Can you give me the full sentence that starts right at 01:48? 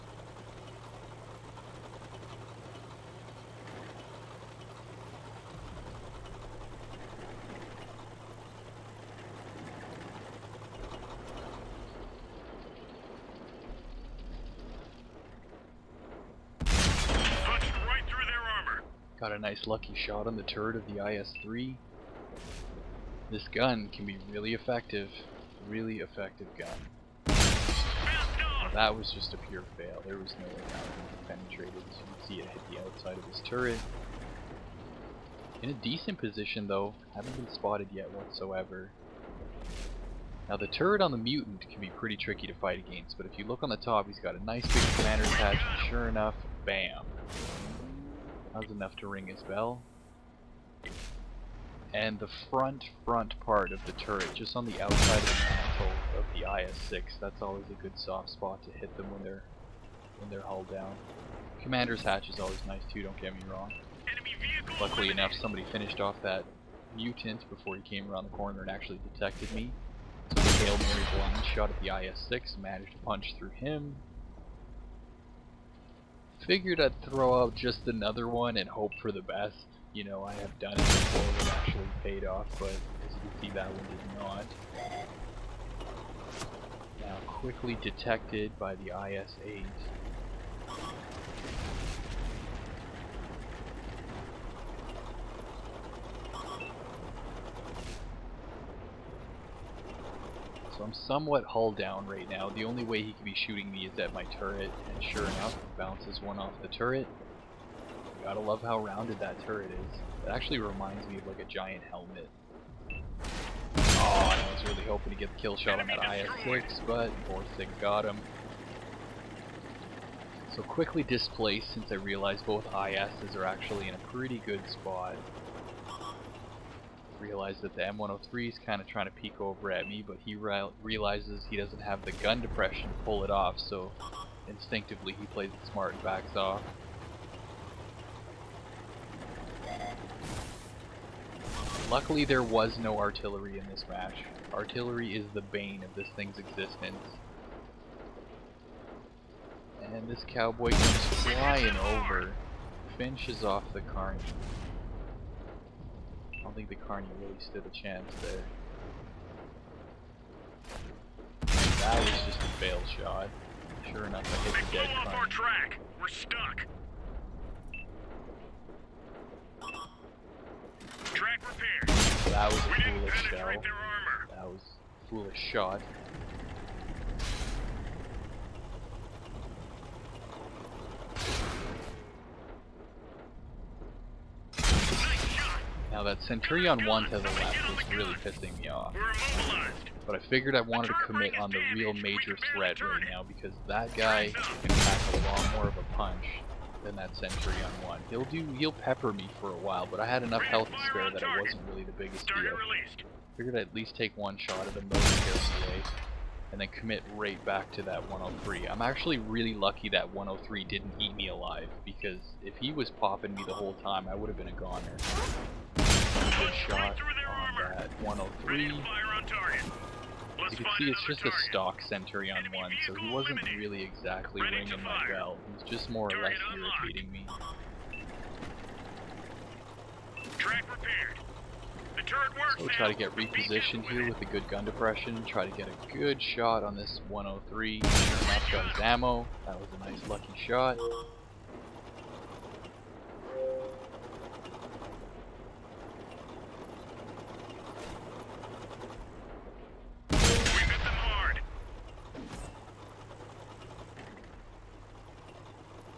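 gotta love how rounded that turret is.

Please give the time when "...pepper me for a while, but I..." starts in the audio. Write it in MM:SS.
03:18.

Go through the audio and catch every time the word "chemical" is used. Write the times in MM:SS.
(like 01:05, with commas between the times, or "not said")
not said.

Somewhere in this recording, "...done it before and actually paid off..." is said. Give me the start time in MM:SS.
01:20.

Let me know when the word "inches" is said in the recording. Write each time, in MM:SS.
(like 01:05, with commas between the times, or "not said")
not said.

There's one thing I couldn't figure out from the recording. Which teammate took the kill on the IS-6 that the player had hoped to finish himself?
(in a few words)
Borsig.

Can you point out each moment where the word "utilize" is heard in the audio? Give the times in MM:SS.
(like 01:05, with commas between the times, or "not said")
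not said.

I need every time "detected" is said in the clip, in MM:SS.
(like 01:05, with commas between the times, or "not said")
01:09, 01:27.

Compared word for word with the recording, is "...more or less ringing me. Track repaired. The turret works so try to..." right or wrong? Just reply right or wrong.
wrong.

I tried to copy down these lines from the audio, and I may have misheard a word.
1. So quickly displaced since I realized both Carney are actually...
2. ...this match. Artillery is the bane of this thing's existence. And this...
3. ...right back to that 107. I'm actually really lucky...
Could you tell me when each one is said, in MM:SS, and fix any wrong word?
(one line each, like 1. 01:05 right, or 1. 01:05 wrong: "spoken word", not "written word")
1. 02:00 wrong: "ISs", not "Carney"
2. 02:23 right
3. 03:27 wrong: "103", not "107".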